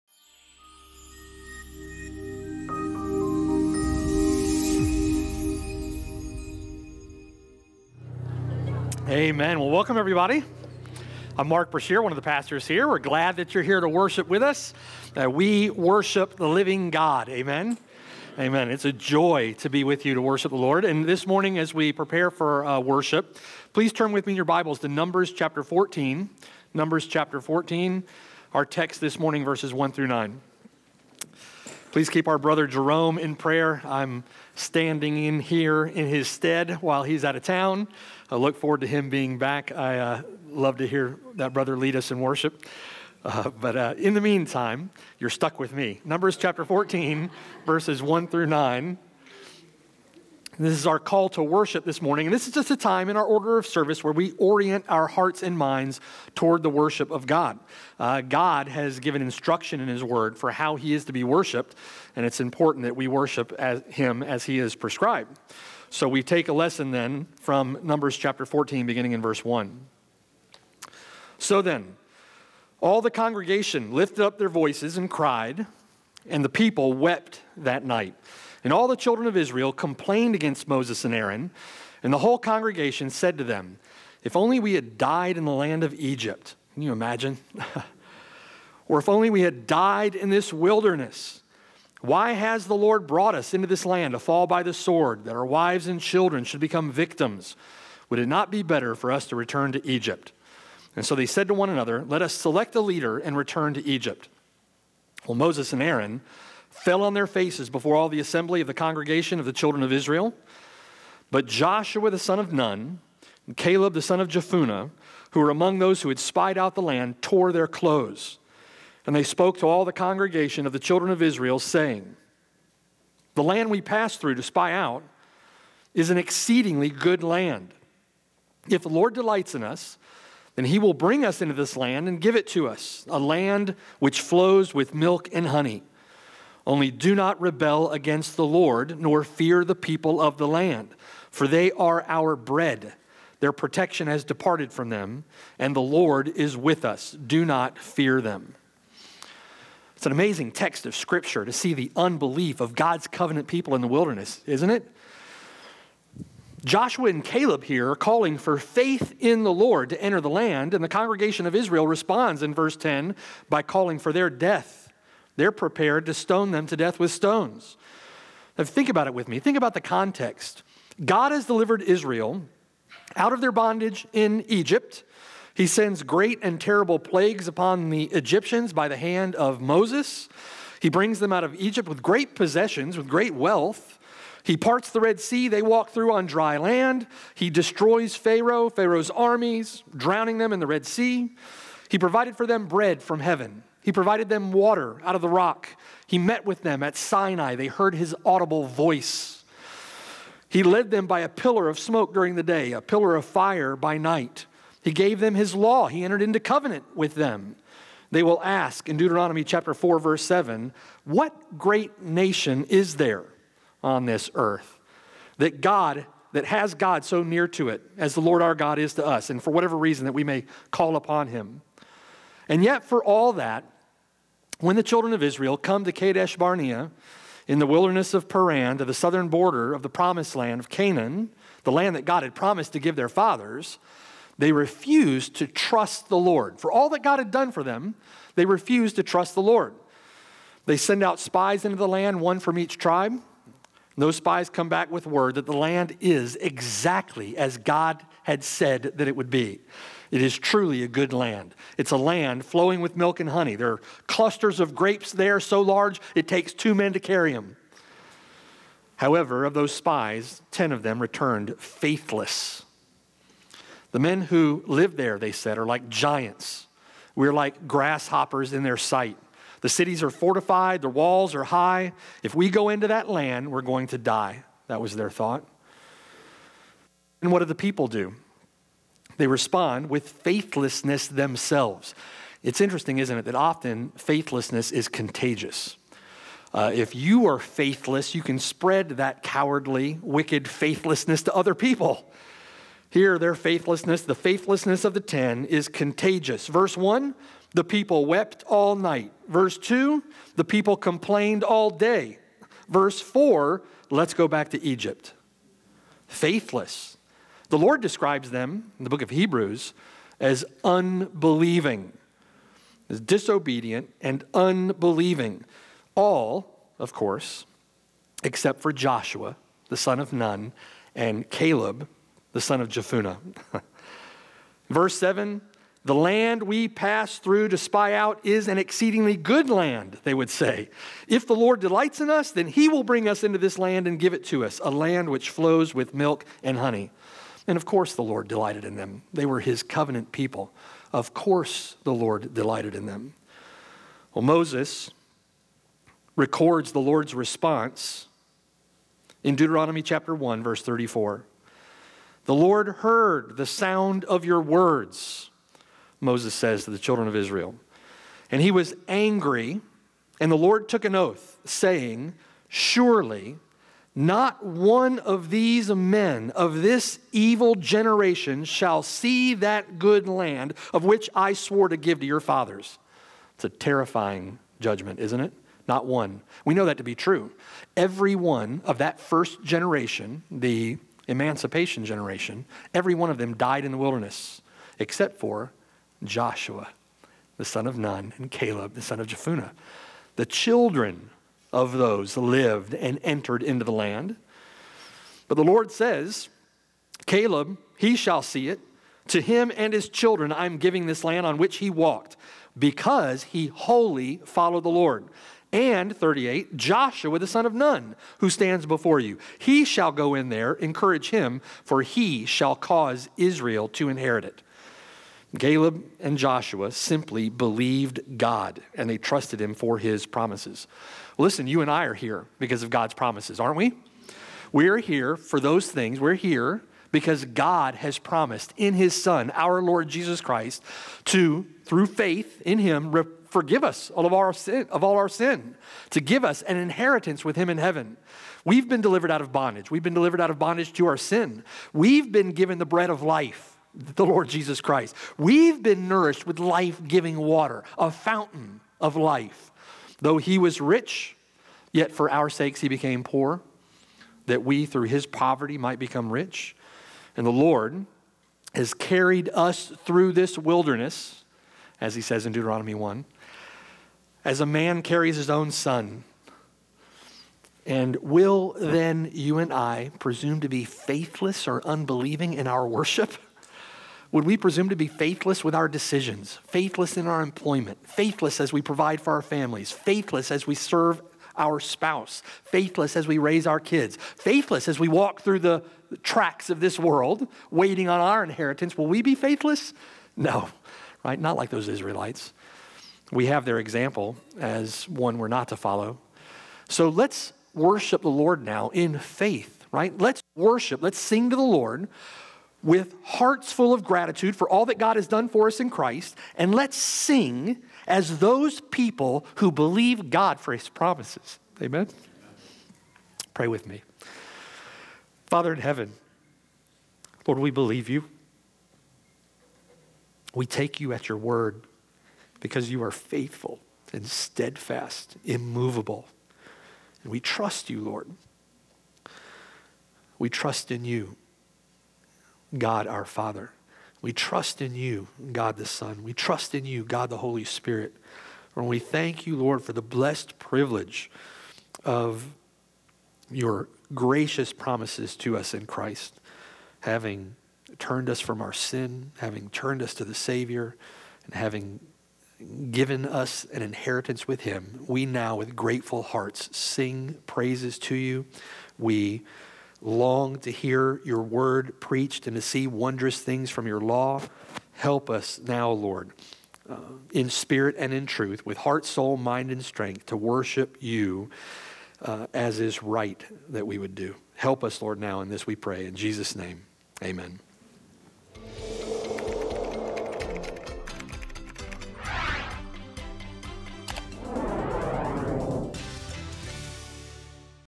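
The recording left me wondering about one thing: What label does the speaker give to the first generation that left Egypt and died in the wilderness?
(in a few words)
the emancipation generation.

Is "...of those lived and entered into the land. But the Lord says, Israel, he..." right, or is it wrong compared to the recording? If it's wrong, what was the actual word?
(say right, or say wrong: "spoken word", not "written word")
wrong: "Caleb", not "Israel".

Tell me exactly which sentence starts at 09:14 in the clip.
We now, with grateful hearts, sing praises to you.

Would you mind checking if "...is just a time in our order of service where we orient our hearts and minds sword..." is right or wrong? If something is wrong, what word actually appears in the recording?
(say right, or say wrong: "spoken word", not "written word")
wrong: "toward", not "sword".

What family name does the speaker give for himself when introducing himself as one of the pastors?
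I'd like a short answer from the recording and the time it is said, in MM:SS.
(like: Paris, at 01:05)
Brashear, at 00:11.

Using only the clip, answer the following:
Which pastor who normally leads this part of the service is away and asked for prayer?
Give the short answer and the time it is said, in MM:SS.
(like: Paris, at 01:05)
Jerome, at 00:32.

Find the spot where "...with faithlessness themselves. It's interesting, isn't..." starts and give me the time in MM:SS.
04:39.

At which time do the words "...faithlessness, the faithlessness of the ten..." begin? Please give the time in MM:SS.
04:53.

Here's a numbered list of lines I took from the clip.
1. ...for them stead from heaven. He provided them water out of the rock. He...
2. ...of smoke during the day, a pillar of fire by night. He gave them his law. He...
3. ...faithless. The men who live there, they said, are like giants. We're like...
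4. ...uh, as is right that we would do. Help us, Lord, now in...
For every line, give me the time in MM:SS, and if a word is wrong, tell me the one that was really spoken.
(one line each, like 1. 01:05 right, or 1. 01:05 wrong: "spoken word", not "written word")
1. 03:12 wrong: "bread", not "stead"
2. 03:21 right
3. 04:21 right
4. 09:32 right.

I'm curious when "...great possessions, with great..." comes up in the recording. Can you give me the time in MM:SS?
03:02.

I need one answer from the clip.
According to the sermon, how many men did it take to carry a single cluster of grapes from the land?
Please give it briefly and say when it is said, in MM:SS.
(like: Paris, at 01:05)
2, at 04:16.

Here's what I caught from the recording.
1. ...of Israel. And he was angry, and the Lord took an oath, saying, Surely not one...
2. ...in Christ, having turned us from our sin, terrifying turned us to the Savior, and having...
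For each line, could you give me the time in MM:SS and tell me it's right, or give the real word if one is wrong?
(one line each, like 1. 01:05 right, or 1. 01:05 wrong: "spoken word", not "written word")
1. 05:57 right
2. 09:05 wrong: "having", not "terrifying".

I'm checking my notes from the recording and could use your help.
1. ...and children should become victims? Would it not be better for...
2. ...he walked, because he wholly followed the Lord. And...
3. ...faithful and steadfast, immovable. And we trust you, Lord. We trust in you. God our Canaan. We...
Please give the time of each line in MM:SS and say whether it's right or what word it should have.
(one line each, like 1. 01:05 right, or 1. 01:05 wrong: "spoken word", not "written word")
1. 01:35 right
2. 06:41 right
3. 08:42 wrong: "Father", not "Canaan".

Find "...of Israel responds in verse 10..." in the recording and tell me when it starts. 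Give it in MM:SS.
02:41.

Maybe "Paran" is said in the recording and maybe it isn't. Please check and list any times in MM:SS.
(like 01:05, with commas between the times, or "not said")
03:48.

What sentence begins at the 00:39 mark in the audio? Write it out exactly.
I uh, love to hear that brother lead us in worship.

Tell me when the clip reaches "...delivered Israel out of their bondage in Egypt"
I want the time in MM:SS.
02:51.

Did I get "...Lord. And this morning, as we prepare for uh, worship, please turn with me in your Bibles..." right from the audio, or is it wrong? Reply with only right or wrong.
right.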